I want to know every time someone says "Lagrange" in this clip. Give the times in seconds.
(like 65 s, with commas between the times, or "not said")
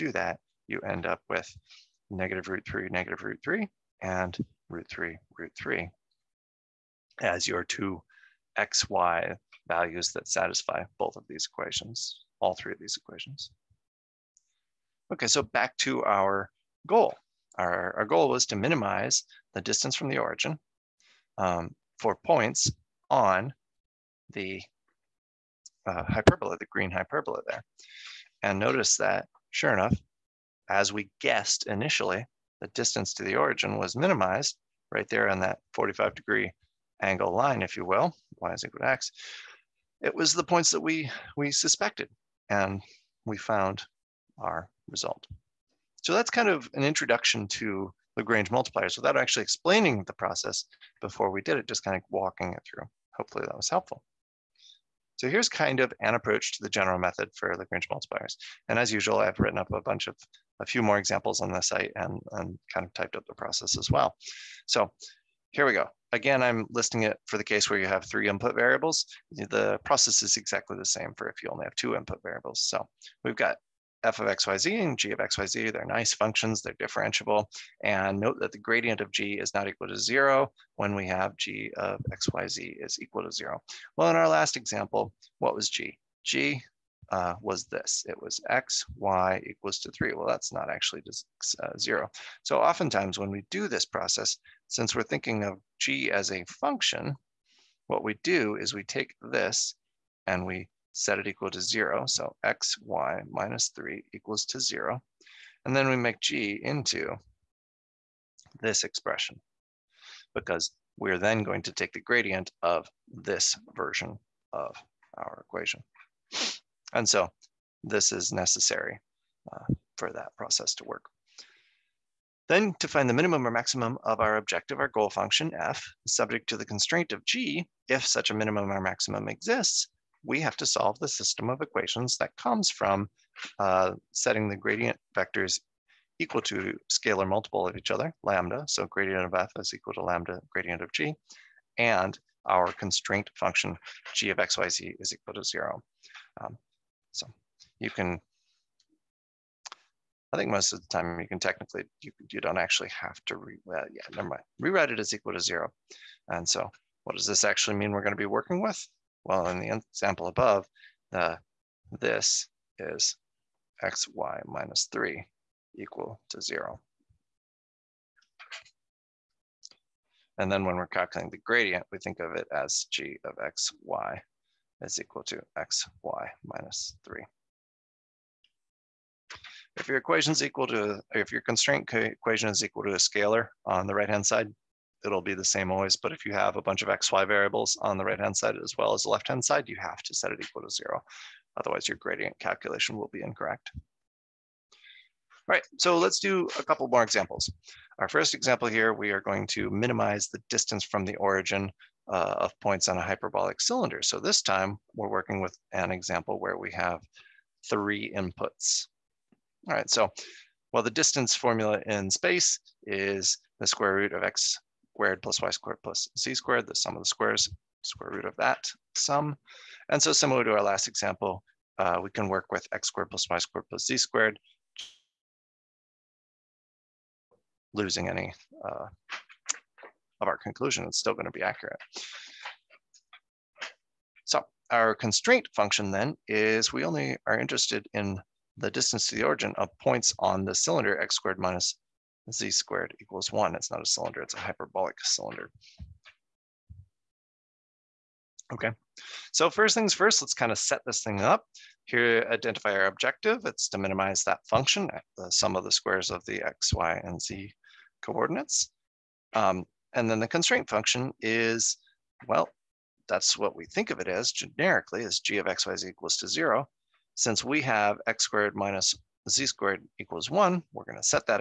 48 s, 57 s.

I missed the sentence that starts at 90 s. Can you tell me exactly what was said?
Well, that's not actually just uh, 0.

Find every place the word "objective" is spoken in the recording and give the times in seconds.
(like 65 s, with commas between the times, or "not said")
124 s, 252 s.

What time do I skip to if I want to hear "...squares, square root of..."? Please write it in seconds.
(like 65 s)
217 s.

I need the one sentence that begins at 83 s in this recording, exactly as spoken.
Well, in our last example, what was g?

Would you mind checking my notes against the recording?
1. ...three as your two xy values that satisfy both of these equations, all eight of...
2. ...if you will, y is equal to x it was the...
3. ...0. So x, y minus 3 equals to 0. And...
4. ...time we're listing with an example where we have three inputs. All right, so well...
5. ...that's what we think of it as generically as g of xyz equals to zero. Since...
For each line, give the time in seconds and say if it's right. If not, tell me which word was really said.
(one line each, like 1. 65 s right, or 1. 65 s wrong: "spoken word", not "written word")
1. 5 s wrong: "three", not "eight"
2. 37 s right
3. 101 s right
4. 204 s wrong: "working", not "listing"
5. 263 s right.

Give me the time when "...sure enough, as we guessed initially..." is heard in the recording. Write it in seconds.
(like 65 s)
29 s.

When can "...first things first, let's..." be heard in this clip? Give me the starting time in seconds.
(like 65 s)
249 s.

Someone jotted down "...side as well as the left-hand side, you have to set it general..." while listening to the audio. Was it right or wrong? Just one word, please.
wrong.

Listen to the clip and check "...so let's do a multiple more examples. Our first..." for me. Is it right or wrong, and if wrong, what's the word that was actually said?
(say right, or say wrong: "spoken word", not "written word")
wrong: "couple", not "multiple".